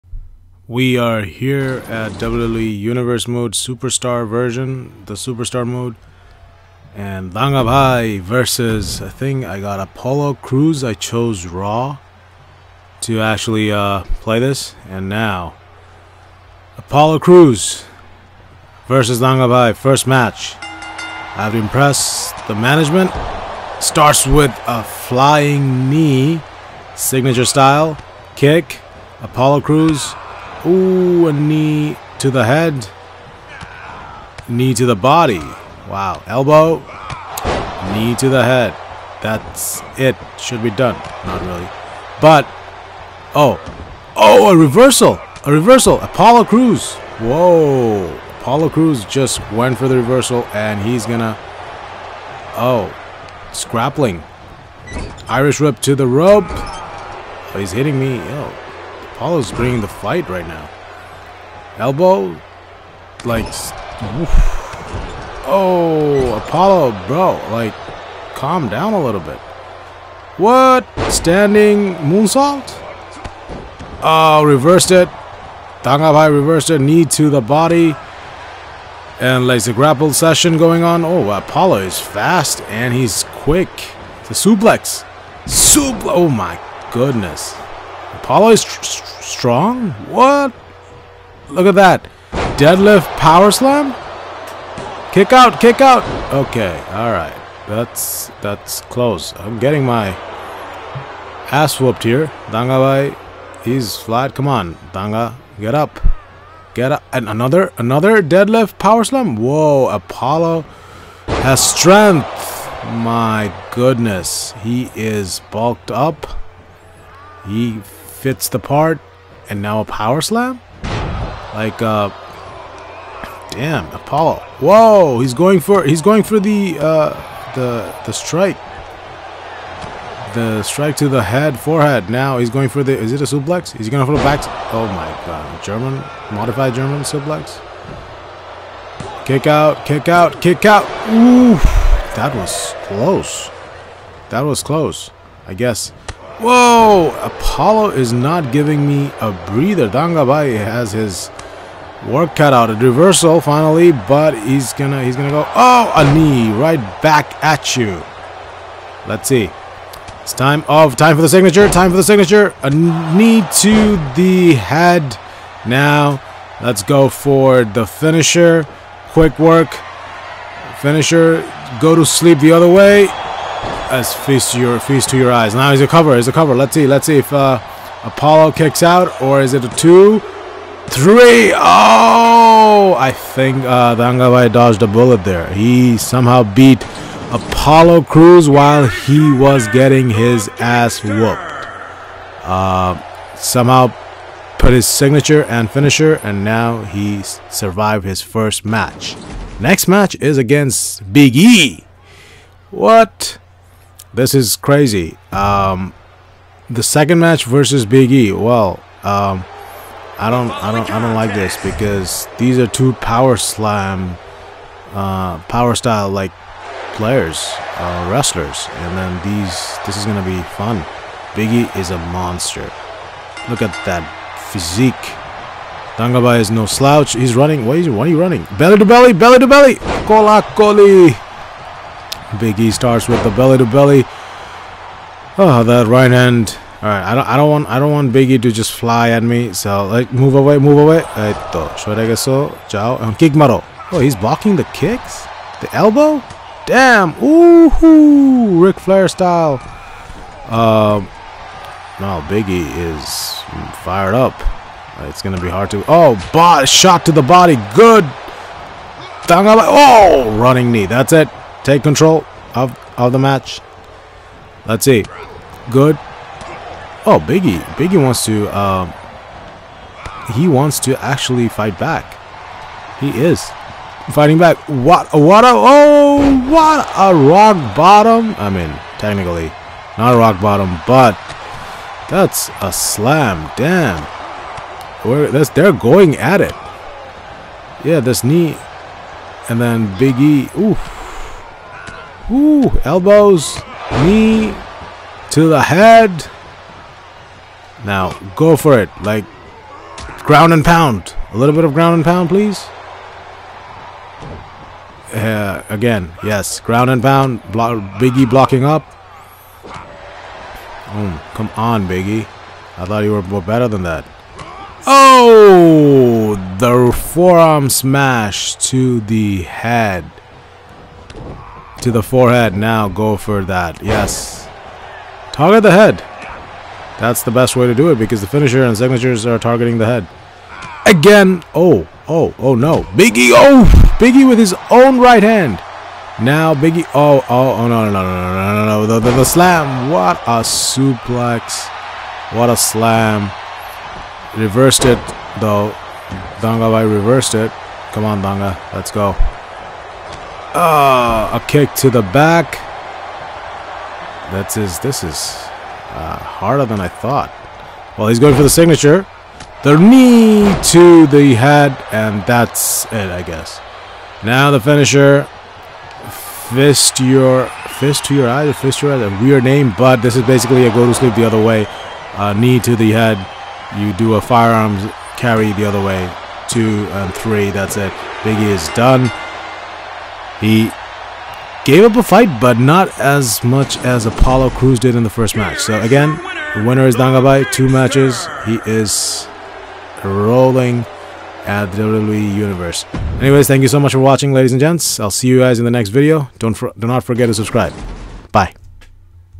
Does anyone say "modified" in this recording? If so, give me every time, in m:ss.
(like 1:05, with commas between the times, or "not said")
2:16.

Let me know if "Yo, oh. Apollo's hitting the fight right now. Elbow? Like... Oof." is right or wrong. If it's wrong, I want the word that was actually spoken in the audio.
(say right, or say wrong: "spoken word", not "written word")
wrong: "bringing", not "hitting".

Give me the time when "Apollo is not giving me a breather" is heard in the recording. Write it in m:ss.
2:27.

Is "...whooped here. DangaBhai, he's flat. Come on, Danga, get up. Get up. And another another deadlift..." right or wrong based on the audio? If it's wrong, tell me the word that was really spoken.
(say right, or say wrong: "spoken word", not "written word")
right.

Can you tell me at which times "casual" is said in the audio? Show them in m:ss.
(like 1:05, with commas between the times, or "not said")
not said.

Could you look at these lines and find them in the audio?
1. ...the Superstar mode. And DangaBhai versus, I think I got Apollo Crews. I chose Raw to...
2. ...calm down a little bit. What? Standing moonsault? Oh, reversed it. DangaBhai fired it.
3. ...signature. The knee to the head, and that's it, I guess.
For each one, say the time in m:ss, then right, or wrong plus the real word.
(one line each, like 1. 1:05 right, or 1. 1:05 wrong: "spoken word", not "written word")
1. 0:05 right
2. 1:08 wrong: "reversed", not "fired"
3. 5:58 right.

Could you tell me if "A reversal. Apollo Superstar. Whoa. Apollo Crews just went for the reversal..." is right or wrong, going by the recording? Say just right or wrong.
wrong.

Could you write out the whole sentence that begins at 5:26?
That's the best way to do it because the finisher and signatures are targeting the head.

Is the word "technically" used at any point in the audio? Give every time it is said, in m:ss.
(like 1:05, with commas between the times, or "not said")
4:38.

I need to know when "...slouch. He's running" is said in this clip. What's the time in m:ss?
3:46.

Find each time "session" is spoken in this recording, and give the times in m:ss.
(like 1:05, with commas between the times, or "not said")
1:20.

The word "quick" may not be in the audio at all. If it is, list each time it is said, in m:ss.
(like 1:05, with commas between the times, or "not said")
1:23, 2:49.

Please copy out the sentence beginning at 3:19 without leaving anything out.
Next match is against Big E.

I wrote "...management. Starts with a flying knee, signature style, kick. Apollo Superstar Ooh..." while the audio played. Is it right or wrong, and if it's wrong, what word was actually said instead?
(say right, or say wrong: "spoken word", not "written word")
wrong: "Crews", not "Superstar".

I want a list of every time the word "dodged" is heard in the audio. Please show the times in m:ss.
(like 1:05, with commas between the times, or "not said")
3:04.